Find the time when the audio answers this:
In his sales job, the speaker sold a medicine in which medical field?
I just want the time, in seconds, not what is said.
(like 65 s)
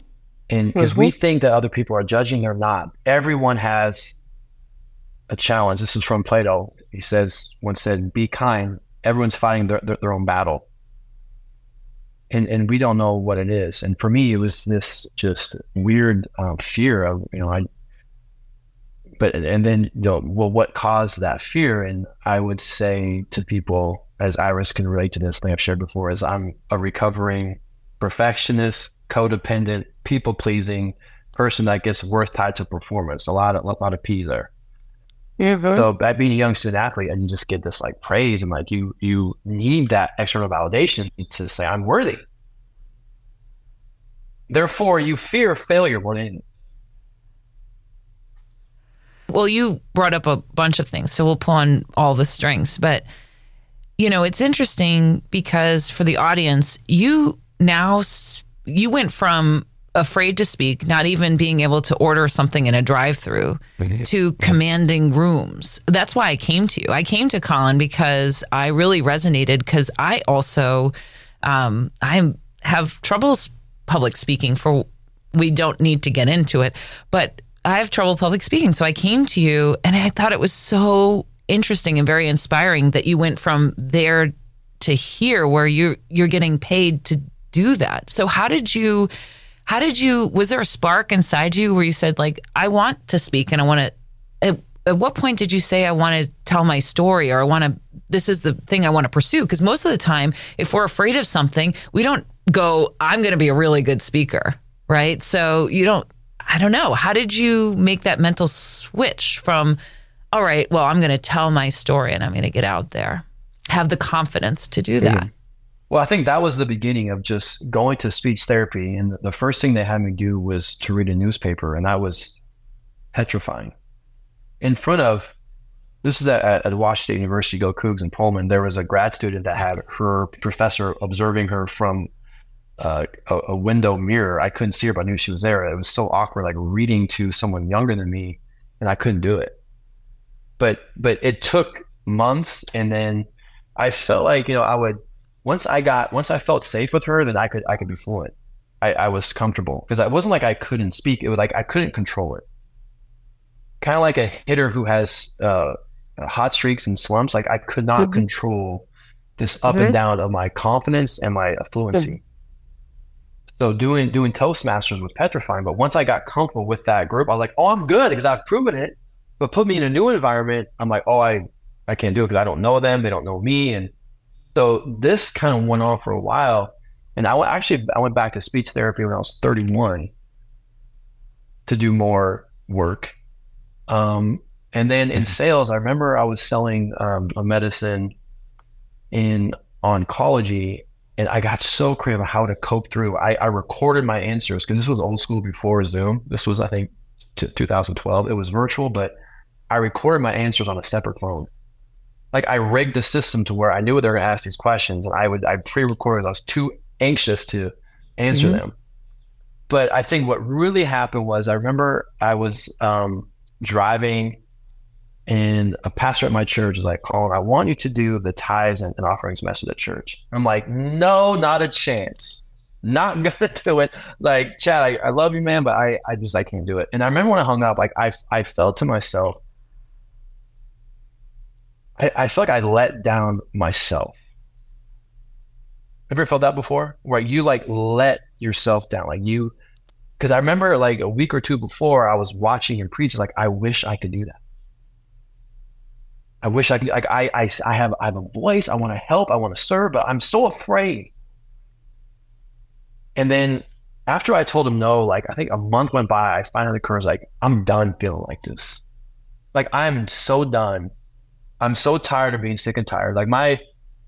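189 s.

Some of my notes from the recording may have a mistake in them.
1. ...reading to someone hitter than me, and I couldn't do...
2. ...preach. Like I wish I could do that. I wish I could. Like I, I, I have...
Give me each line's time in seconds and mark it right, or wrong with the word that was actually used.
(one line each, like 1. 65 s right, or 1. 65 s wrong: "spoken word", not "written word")
1. 136 s wrong: "younger", not "hitter"
2. 242 s right.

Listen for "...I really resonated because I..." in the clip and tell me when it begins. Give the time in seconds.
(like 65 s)
68 s.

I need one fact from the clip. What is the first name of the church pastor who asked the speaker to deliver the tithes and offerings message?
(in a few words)
Chad.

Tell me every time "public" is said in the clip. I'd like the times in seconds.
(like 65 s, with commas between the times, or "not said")
73 s, 78 s.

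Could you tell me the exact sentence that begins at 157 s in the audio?
Like I could not control this up mm-hmm.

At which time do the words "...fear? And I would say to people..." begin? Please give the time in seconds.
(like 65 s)
21 s.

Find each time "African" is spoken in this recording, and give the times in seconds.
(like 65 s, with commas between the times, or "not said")
not said.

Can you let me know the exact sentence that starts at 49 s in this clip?
Well, you brought up a bunch of things, so we'll pull on all the strengths.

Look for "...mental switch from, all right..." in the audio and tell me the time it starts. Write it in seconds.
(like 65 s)
108 s.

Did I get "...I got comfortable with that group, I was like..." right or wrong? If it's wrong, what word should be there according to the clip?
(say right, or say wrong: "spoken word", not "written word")
right.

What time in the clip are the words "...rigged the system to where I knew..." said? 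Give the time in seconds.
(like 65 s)
202 s.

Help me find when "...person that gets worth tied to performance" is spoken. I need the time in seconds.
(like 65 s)
31 s.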